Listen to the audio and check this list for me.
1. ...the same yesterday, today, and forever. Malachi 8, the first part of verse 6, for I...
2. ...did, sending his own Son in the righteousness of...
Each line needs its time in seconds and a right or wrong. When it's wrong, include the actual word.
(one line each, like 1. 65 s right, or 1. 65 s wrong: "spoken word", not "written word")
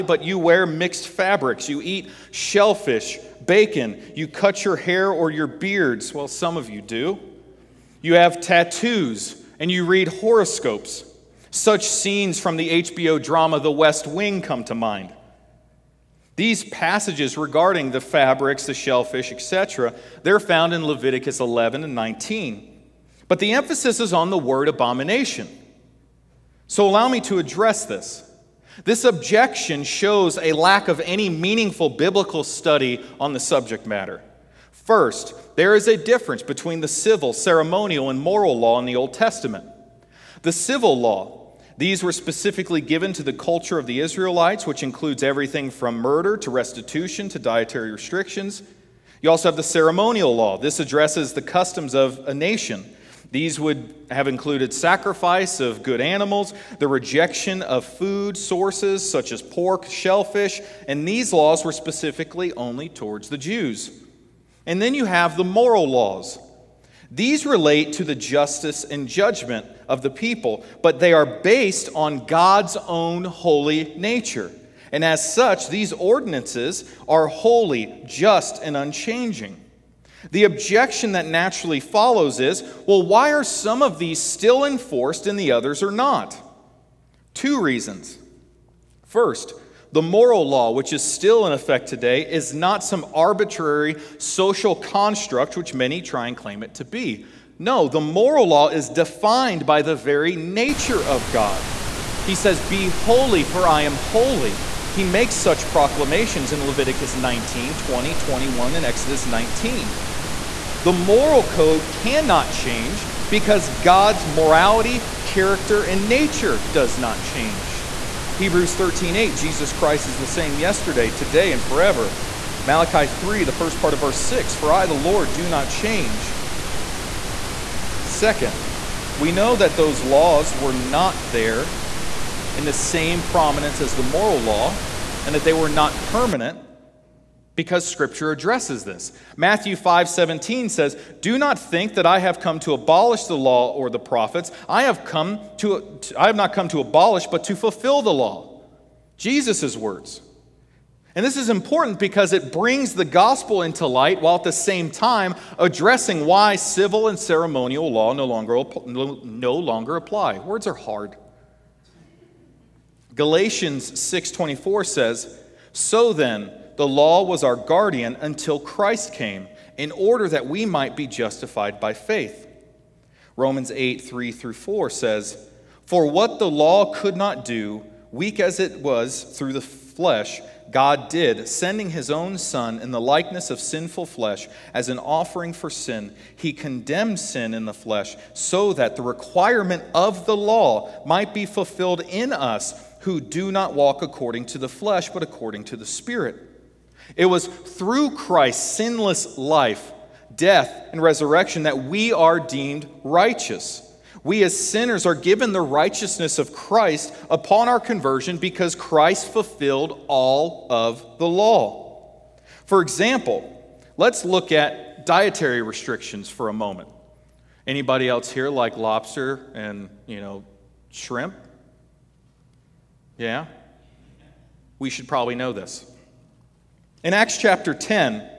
1. 120 s wrong: "3", not "8"
2. 181 s wrong: "likeness", not "righteousness".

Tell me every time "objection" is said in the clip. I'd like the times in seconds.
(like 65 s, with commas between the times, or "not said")
29 s, 80 s.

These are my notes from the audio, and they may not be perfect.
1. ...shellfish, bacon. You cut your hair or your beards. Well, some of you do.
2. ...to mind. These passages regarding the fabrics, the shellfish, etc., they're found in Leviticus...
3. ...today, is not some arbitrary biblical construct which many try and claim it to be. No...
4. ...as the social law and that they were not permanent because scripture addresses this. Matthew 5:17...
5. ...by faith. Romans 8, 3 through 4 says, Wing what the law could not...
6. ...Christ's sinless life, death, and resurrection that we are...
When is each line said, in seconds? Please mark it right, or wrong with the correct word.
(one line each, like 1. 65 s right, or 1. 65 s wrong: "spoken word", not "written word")
1. 2 s right
2. 14 s right
3. 91 s wrong: "social", not "biblical"
4. 133 s wrong: "moral", not "social"
5. 171 s wrong: "For", not "Wing"
6. 198 s right.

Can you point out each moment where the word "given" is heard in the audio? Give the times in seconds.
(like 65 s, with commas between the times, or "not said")
42 s, 205 s.